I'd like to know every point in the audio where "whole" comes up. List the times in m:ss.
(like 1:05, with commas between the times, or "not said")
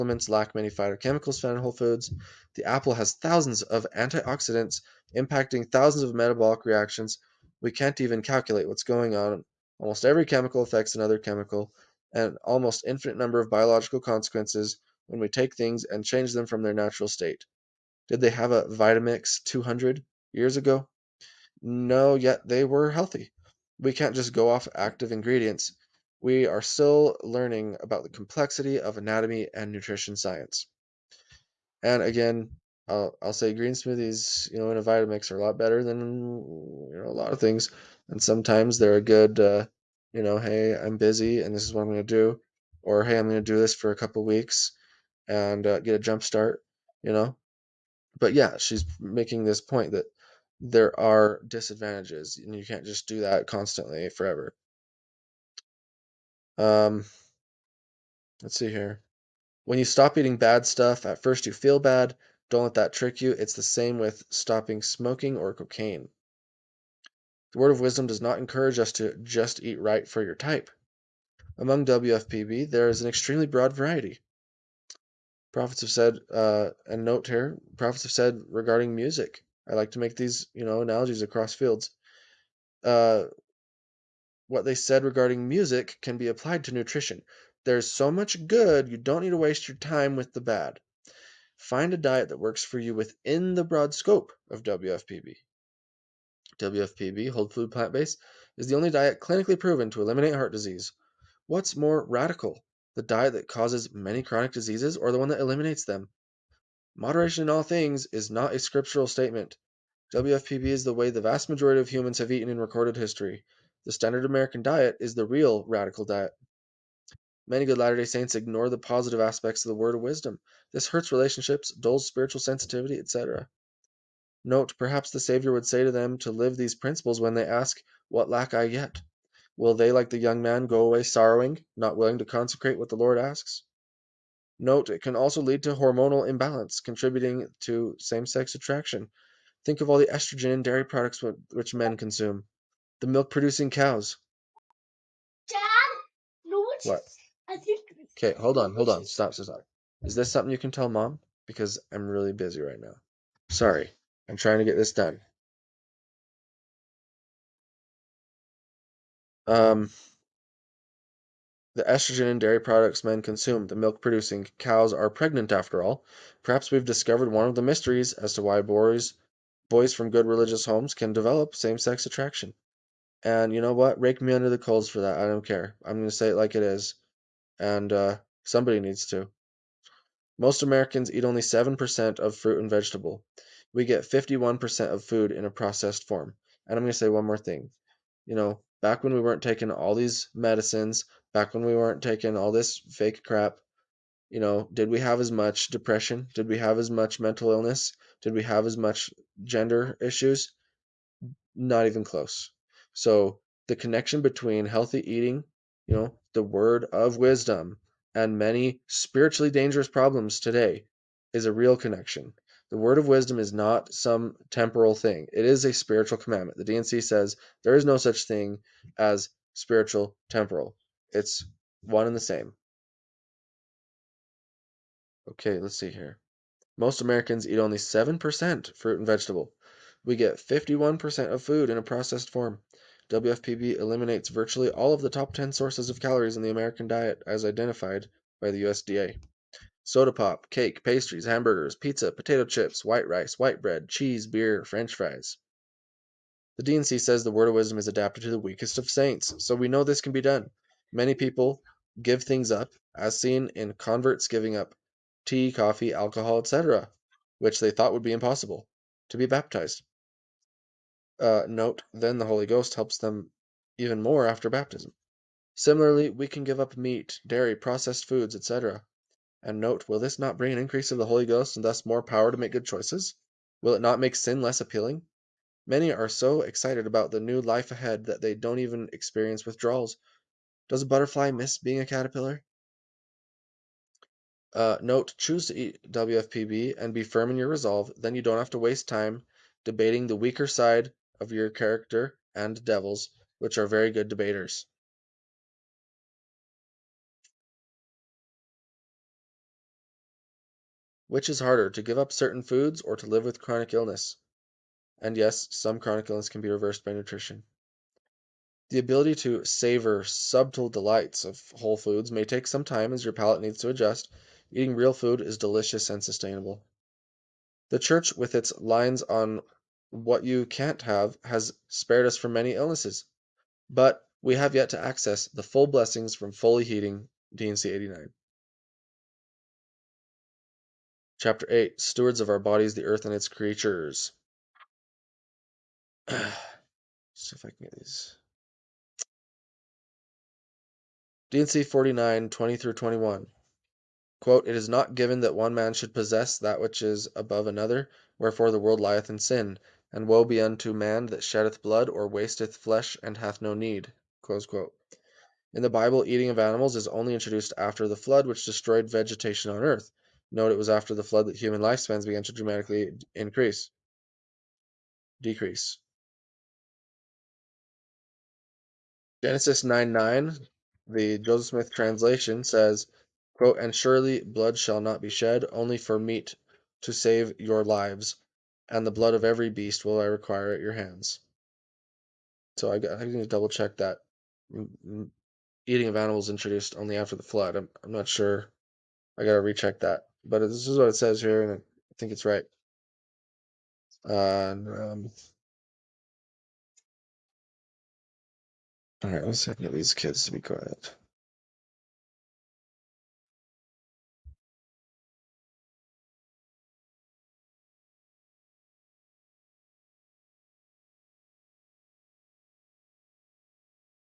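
0:01, 1:37, 5:11.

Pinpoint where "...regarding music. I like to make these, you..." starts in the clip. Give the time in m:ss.
1:18.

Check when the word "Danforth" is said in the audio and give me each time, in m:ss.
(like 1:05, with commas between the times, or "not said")
not said.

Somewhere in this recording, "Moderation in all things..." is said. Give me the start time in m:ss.
1:46.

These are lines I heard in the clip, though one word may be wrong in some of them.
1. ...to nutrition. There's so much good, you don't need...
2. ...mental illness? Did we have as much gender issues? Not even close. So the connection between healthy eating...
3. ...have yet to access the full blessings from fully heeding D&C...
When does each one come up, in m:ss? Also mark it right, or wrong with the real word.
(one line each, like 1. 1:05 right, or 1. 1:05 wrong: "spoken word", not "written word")
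1. 1:26 right
2. 3:17 right
3. 5:24 right.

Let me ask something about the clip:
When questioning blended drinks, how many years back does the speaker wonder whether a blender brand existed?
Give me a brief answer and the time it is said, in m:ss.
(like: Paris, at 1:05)
200 years, at 0:19.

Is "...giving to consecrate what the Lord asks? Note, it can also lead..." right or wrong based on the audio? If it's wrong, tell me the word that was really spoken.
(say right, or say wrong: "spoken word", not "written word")
wrong: "willing", not "giving".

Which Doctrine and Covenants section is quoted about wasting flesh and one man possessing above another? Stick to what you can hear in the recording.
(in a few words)
D&C 49:20-21.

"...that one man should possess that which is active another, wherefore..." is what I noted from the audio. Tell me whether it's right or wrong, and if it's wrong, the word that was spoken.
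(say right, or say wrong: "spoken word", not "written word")
wrong: "above", not "active".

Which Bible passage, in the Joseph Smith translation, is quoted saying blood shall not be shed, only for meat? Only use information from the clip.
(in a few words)
Genesis 9:9.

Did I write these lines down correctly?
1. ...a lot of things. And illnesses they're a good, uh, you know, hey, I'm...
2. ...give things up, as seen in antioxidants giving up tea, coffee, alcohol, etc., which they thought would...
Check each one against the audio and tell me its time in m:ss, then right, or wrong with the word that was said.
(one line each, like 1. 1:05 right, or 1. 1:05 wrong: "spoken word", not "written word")
1. 0:37 wrong: "sometimes", not "illnesses"
2. 4:12 wrong: "converts", not "antioxidants".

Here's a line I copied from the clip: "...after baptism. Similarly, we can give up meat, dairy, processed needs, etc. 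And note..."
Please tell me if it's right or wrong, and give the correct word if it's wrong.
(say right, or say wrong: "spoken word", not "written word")
wrong: "foods", not "needs".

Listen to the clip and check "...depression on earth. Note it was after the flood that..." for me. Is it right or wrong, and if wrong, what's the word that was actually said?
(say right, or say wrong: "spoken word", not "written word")
wrong: "vegetation", not "depression".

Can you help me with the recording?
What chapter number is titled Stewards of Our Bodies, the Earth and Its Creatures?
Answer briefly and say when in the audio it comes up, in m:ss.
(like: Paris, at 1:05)
8, at 5:31.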